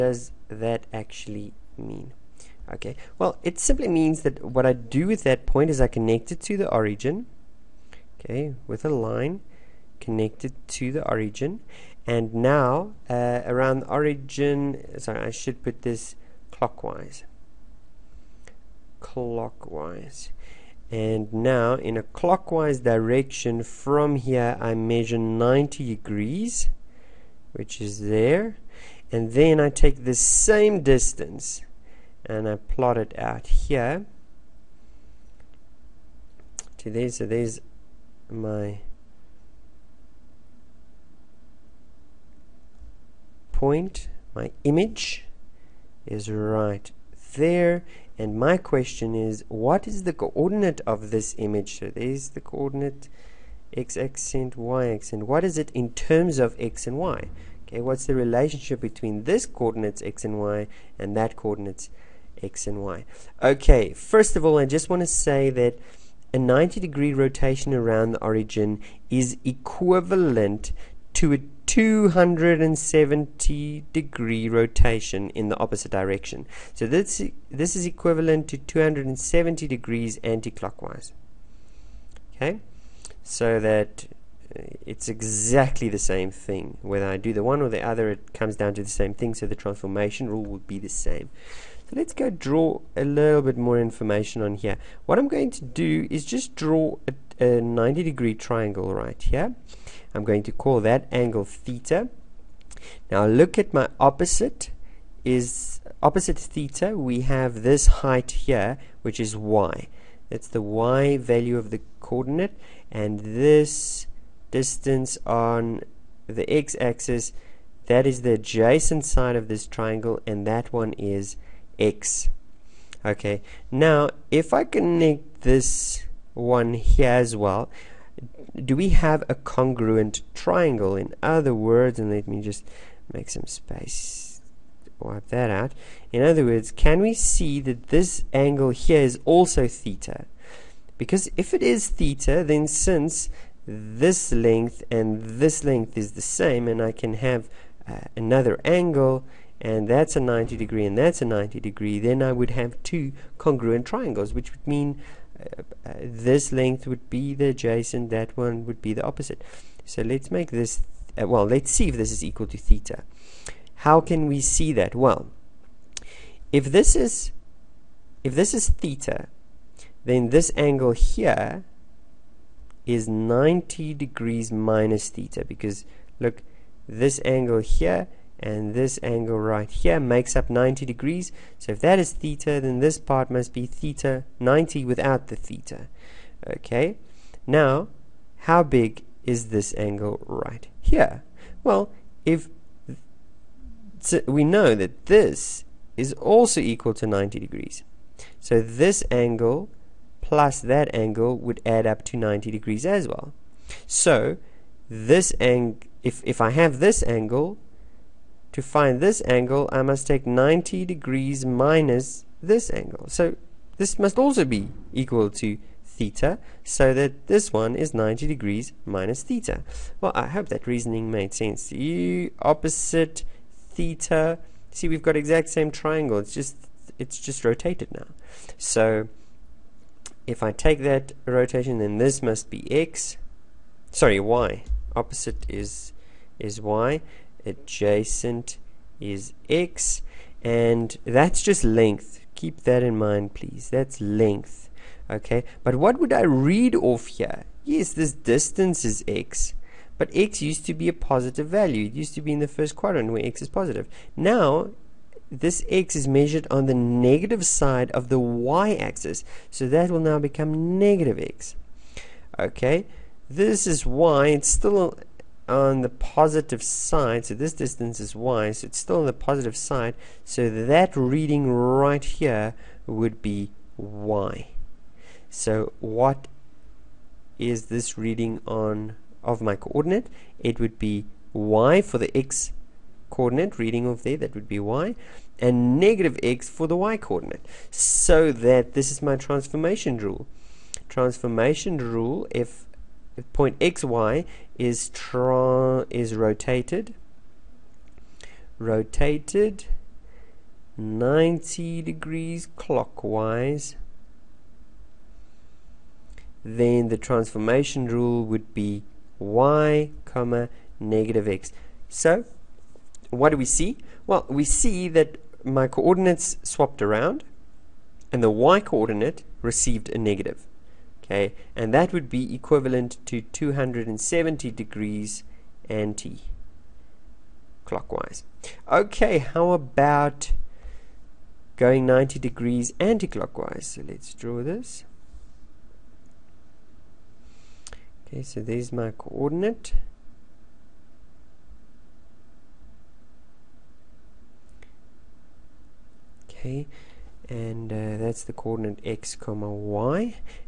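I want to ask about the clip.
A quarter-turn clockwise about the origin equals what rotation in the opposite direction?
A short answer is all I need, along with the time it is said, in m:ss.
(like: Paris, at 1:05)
270 degrees anti-clockwise, at 1:18.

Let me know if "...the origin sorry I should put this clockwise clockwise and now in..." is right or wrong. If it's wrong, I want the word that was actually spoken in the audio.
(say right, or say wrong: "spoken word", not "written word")
right.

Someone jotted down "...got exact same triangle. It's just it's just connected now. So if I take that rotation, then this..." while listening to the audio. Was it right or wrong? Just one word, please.
wrong.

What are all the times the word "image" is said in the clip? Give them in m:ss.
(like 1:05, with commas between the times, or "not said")
0:44, 0:51.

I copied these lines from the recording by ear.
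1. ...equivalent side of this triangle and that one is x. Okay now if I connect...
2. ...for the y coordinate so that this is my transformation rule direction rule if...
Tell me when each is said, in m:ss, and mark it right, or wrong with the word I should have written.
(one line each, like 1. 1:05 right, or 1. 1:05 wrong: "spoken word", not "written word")
1. 1:58 wrong: "adjacent", not "equivalent"
2. 4:46 wrong: "transformation", not "direction".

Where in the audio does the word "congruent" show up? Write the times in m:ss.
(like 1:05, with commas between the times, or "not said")
2:09, 2:33.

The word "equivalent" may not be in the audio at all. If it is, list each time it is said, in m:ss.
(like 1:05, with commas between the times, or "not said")
1:09, 1:17, 5:22.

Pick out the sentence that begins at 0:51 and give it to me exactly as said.
So there's the coordinate x accent, y accent.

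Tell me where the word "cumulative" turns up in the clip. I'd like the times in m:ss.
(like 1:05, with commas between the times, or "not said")
not said.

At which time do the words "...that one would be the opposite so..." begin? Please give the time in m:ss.
2:38.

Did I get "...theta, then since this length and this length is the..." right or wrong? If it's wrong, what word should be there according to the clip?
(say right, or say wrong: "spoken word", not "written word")
right.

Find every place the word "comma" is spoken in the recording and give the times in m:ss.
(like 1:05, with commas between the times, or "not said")
5:10, 5:49.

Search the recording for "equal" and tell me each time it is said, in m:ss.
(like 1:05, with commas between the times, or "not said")
2:42, 3:16, 3:34.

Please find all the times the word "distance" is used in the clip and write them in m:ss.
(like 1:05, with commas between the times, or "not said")
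0:30, 1:54, 4:08, 4:27.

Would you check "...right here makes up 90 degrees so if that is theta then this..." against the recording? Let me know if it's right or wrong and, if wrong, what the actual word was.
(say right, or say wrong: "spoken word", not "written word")
right.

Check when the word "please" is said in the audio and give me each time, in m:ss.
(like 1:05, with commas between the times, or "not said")
4:03.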